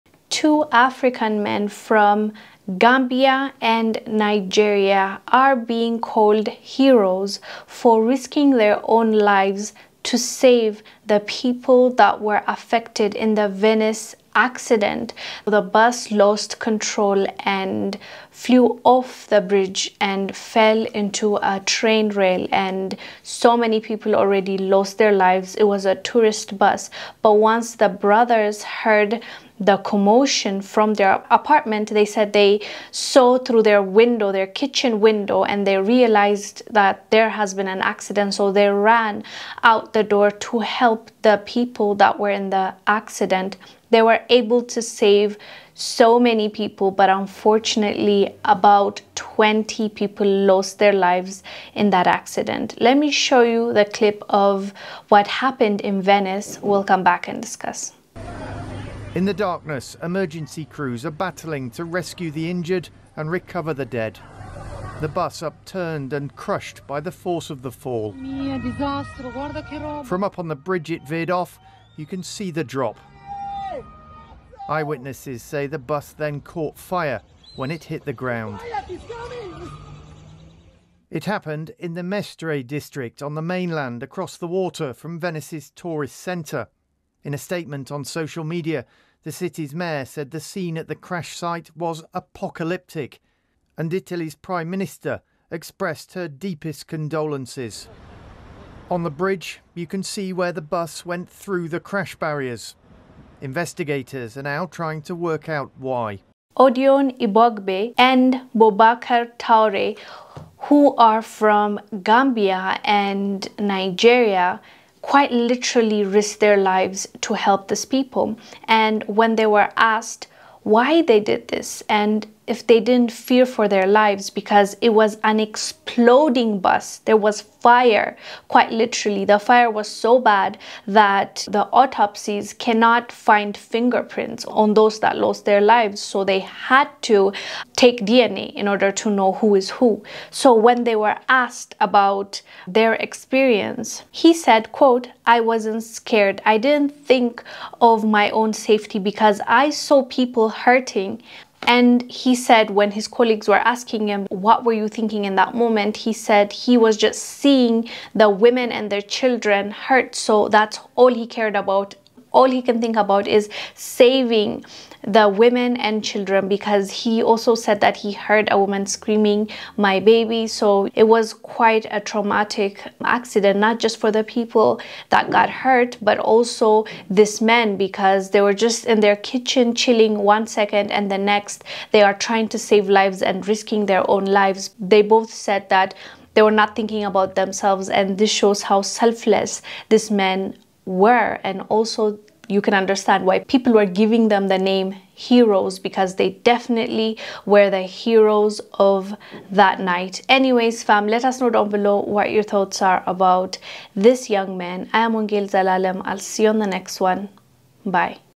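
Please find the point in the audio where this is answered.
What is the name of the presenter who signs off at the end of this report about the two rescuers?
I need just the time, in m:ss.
3:25.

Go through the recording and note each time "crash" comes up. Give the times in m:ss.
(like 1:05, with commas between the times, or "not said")
1:30, 1:41.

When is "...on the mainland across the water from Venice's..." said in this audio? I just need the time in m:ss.
1:23.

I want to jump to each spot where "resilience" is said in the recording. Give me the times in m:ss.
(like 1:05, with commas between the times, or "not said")
not said.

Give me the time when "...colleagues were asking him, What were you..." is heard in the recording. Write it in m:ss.
2:33.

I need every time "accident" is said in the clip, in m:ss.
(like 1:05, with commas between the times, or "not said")
0:14, 0:37, 0:42, 0:52, 2:53.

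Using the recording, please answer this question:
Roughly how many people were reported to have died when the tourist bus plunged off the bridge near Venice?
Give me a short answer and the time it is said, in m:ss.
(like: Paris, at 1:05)
20, at 0:48.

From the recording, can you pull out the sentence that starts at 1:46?
Odion Ibogbe and Boubakar Toure, who are from Gambia and Nigeria, quite literally risked their lives to help these people.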